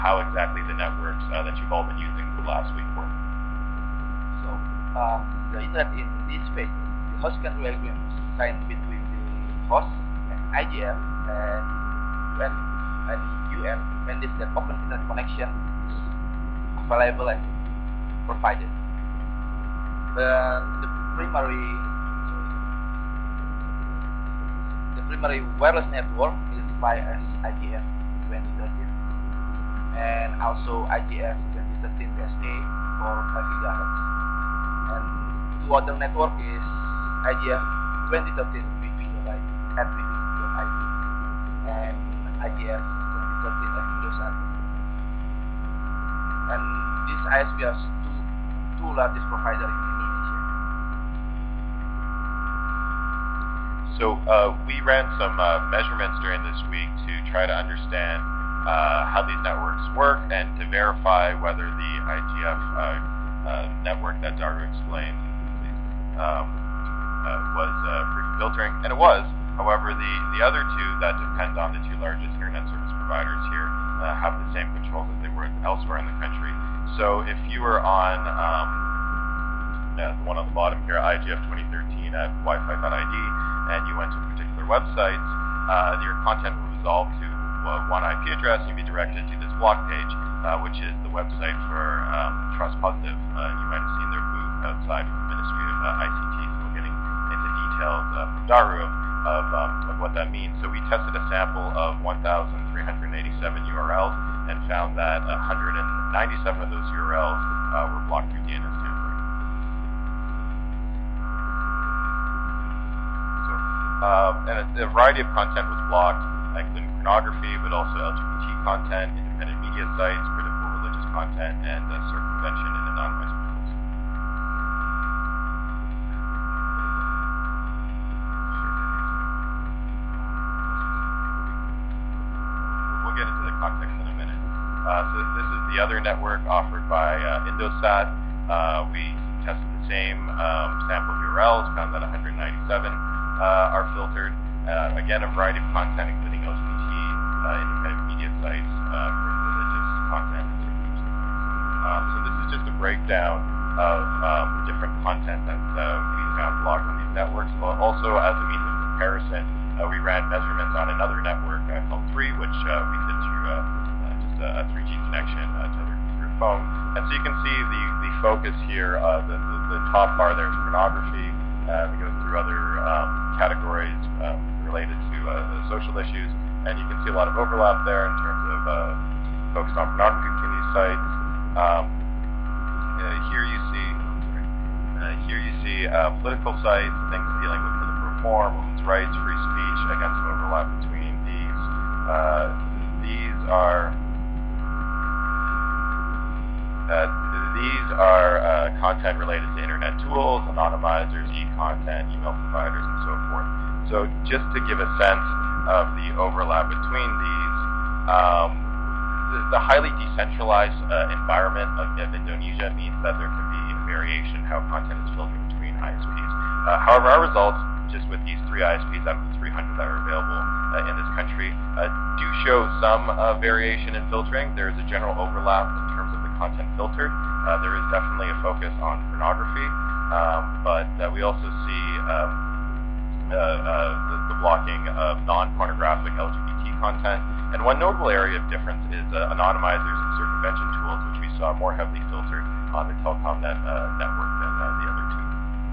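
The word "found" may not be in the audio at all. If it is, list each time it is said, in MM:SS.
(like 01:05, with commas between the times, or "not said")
01:44, 02:21, 02:36.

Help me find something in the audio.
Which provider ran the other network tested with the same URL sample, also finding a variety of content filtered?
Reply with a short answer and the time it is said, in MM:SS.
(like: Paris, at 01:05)
Indosat, at 02:17.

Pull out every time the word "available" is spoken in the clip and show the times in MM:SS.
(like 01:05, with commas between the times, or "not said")
00:16, 03:40.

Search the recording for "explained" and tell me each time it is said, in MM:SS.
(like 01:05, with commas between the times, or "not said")
01:04.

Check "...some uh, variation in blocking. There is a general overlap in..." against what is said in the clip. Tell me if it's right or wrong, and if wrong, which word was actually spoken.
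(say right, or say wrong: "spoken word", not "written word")
wrong: "filtering", not "blocking".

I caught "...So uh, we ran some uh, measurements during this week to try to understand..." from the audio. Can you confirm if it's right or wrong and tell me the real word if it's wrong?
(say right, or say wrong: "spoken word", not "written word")
right.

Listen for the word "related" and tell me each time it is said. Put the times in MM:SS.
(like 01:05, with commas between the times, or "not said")
02:54, 03:19.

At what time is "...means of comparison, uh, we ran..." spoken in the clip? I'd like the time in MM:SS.
02:38.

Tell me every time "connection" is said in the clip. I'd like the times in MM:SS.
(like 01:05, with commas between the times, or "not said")
00:15, 02:45.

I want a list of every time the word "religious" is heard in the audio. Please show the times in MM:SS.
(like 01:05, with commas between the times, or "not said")
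02:00, 02:29.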